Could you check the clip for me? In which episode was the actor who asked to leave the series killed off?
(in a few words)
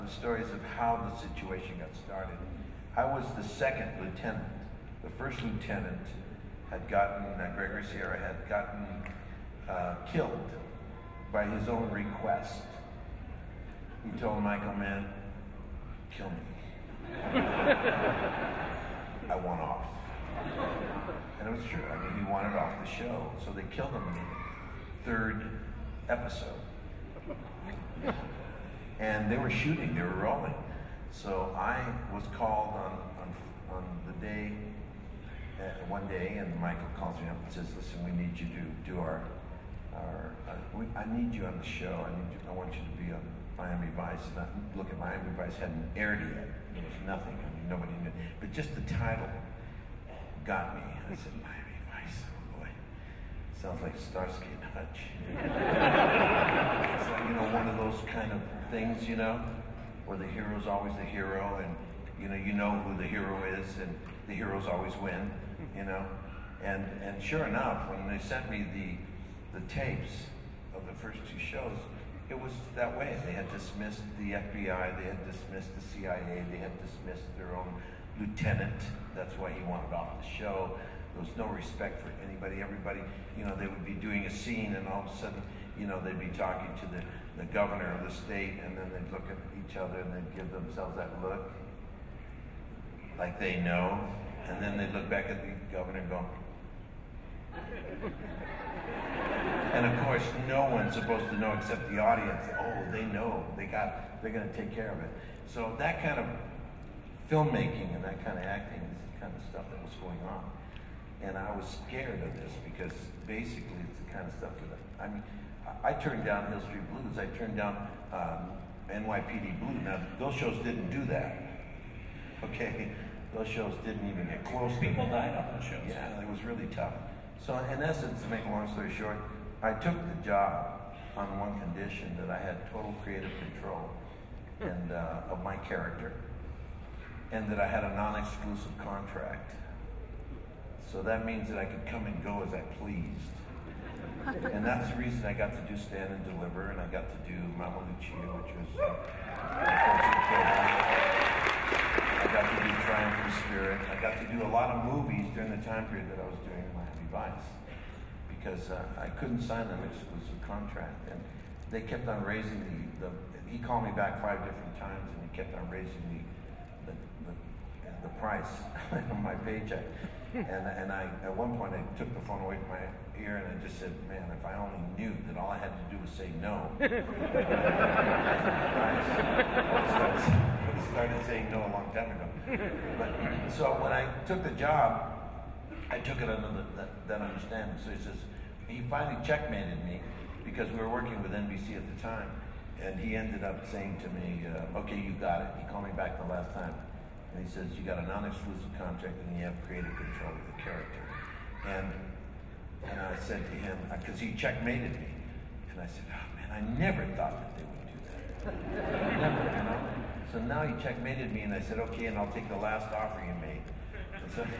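Third episode.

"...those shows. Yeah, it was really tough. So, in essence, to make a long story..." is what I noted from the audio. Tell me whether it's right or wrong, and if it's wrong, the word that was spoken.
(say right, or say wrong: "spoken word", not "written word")
right.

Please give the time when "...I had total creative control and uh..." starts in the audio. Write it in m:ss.
2:12.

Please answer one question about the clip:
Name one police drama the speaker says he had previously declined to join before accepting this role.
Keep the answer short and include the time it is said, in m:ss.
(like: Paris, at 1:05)
Hill Street Blues, at 1:56.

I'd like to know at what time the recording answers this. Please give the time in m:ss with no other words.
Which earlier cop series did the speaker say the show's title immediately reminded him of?
0:53.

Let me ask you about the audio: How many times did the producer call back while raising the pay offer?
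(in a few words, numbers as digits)
5.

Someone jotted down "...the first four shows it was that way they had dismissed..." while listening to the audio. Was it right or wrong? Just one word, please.
wrong.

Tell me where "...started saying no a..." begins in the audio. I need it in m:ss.
3:00.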